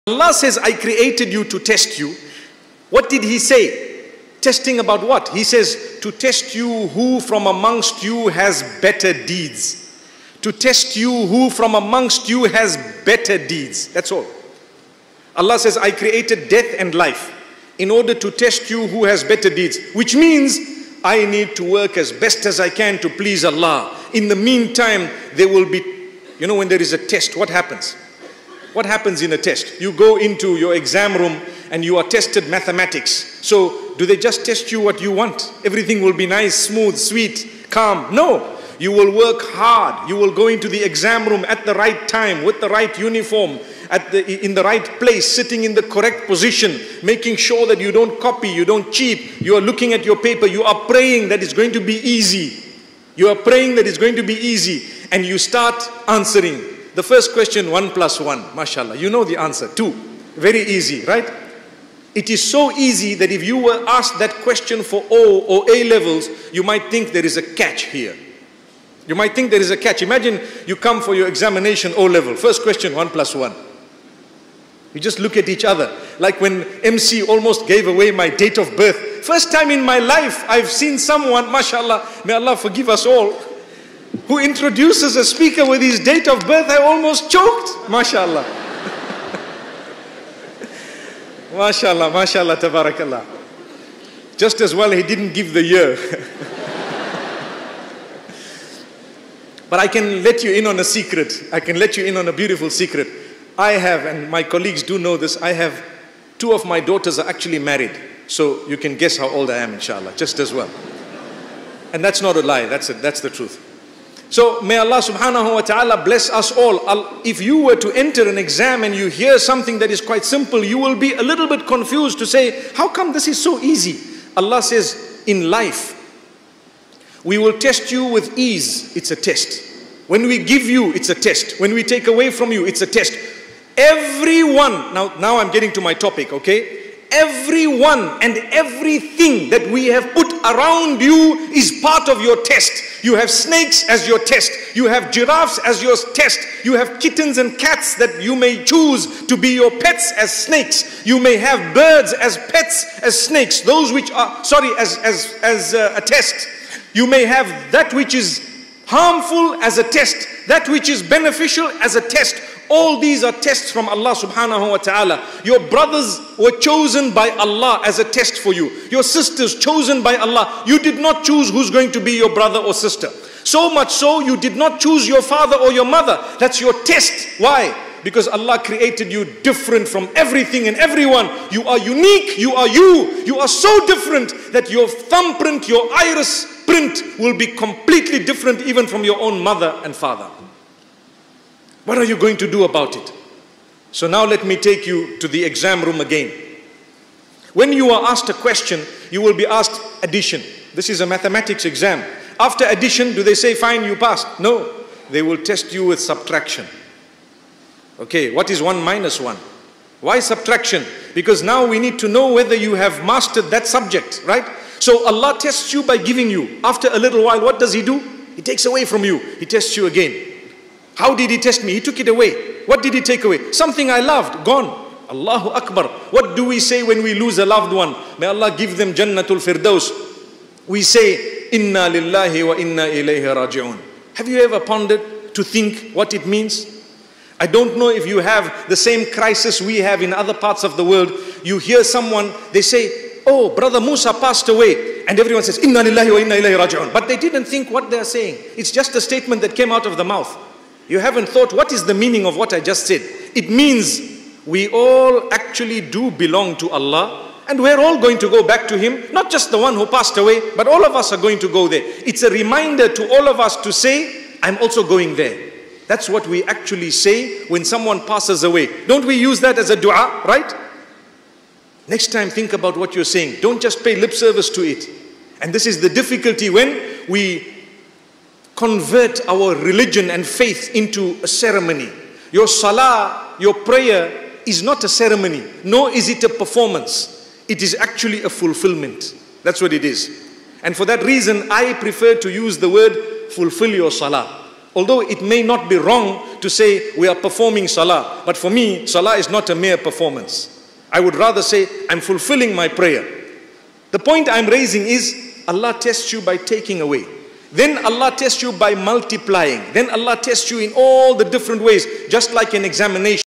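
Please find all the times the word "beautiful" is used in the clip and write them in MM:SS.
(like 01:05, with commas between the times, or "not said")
01:42.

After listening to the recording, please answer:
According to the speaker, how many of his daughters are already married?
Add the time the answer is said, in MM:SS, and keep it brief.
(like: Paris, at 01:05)
2, at 01:46.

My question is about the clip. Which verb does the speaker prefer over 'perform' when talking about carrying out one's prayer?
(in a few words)
fulfill.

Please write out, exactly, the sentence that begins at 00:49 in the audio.
You are looking at your paper.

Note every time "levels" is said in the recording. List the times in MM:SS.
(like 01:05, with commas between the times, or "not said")
01:05, 01:12.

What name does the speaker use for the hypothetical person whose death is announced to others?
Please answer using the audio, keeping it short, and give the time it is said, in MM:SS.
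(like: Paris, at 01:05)
Musa, at 04:03.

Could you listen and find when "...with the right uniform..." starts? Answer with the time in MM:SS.
00:42.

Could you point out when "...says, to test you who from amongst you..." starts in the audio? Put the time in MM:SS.
00:05.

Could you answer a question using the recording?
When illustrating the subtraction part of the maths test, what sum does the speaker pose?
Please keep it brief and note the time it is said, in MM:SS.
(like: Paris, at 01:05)
1 minus 1, at 03:28.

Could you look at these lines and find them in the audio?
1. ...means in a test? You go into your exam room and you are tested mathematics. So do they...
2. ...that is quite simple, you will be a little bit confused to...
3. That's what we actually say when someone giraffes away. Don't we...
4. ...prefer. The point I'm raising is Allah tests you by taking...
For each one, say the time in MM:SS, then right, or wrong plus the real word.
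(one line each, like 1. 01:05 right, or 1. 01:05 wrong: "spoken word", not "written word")
1. 00:28 wrong: "happens", not "means"
2. 01:59 right
3. 04:25 wrong: "passes", not "giraffes"
4. 05:02 wrong: "prayer", not "prefer".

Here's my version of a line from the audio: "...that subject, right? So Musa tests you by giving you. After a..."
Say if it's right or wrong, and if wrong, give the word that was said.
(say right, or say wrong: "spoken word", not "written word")
wrong: "Allah", not "Musa".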